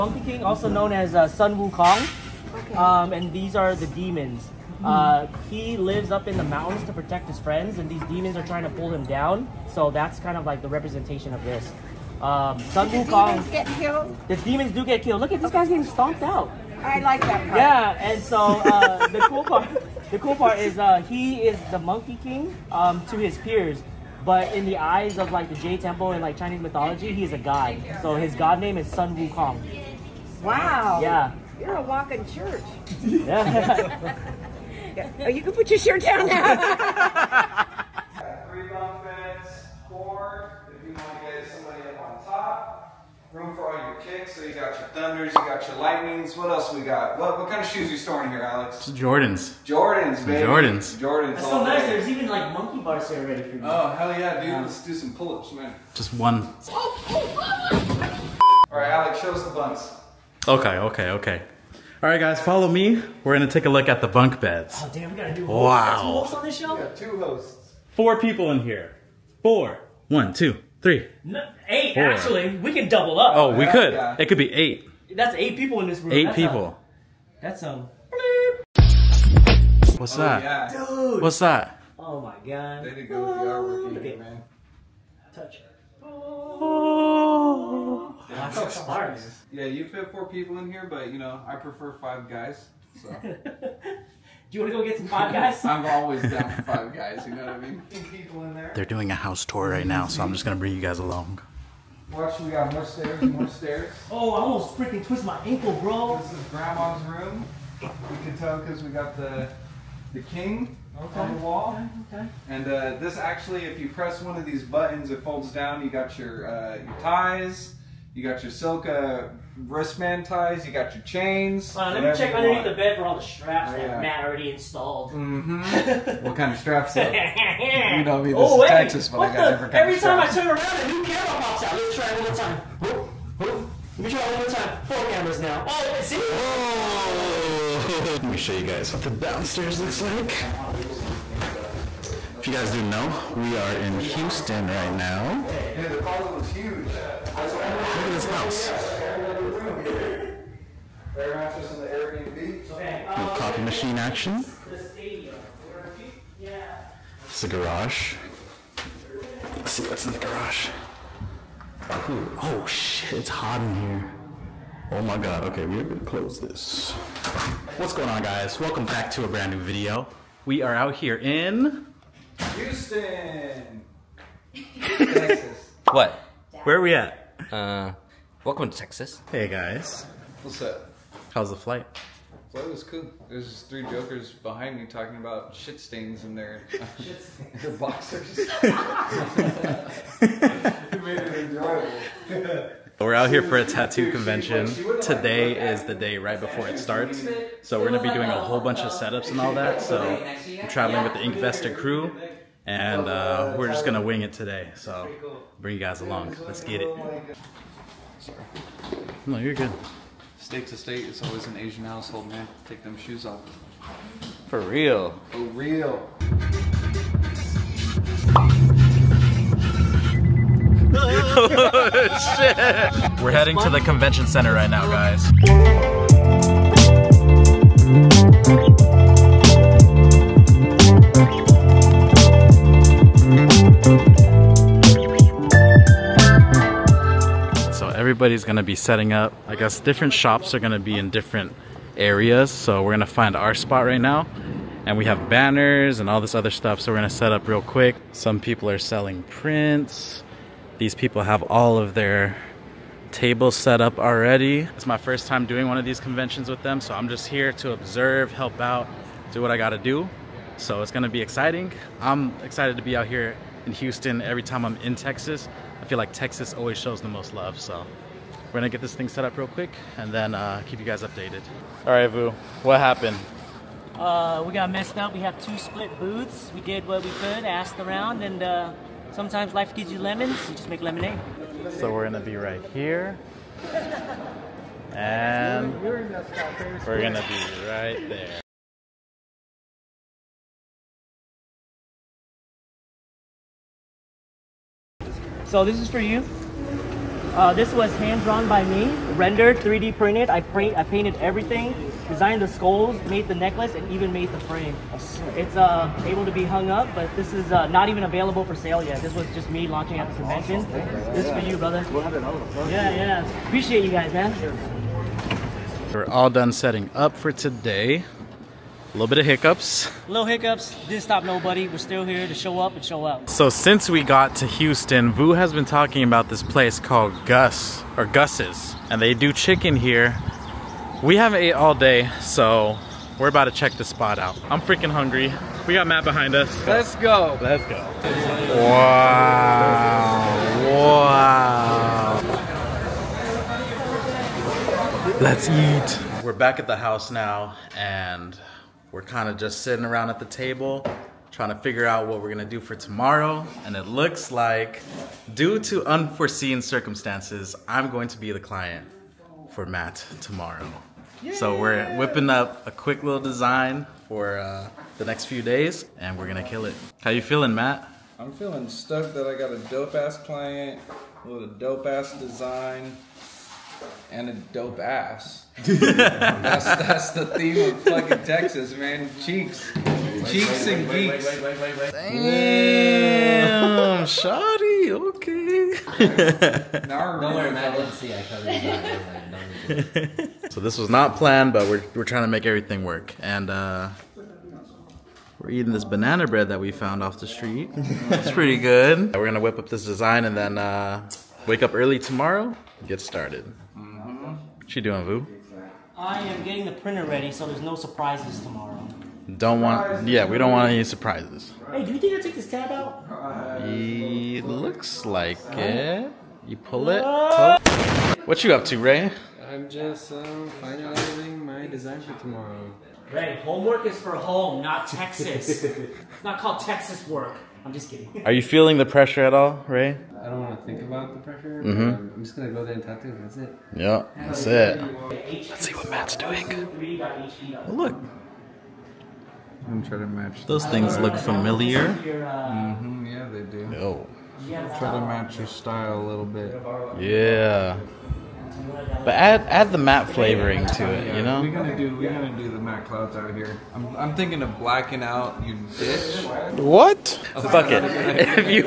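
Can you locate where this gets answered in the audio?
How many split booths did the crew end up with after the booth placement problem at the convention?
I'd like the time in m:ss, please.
4:35.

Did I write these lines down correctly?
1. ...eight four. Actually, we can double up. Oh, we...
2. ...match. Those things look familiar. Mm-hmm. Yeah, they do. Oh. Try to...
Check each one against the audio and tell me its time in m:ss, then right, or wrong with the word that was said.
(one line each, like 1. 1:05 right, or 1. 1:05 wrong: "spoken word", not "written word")
1. 1:11 right
2. 7:20 right.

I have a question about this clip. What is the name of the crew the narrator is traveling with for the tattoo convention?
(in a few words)
Inkvested.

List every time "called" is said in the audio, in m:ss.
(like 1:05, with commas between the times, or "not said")
5:26, 7:06.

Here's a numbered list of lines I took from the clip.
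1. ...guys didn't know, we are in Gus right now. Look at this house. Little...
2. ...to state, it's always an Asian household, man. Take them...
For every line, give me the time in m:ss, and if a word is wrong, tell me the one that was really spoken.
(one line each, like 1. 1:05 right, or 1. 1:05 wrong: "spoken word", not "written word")
1. 2:22 wrong: "Houston", not "Gus"
2. 3:30 right.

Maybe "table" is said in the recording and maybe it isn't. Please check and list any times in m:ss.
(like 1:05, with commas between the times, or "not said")
4:13, 5:50.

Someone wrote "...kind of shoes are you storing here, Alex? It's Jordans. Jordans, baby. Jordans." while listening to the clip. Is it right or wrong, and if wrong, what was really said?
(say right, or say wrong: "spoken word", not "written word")
right.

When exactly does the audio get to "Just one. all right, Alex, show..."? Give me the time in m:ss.
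0:55.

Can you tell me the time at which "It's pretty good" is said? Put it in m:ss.
6:37.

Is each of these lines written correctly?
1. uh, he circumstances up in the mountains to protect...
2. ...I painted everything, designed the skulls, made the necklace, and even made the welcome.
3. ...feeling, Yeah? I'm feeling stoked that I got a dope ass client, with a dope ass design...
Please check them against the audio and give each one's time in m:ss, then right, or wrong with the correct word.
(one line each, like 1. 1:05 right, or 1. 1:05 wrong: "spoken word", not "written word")
1. 0:04 wrong: "lives", not "circumstances"
2. 5:00 wrong: "frame", not "welcome"
3. 6:07 wrong: "Matt", not "Yeah".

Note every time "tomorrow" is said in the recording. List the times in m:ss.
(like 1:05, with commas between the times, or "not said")
5:52, 6:00, 6:41, 6:48, 7:02.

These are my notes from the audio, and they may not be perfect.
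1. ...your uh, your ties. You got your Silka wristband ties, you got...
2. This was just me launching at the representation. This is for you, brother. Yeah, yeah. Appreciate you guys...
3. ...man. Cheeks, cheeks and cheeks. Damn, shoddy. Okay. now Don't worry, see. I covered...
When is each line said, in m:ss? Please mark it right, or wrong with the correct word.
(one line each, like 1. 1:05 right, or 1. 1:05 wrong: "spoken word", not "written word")
1. 1:56 right
2. 5:09 wrong: "convention", not "representation"
3. 6:18 wrong: "geeks", not "cheeks".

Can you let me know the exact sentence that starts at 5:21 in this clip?
We're still here to show up and show out.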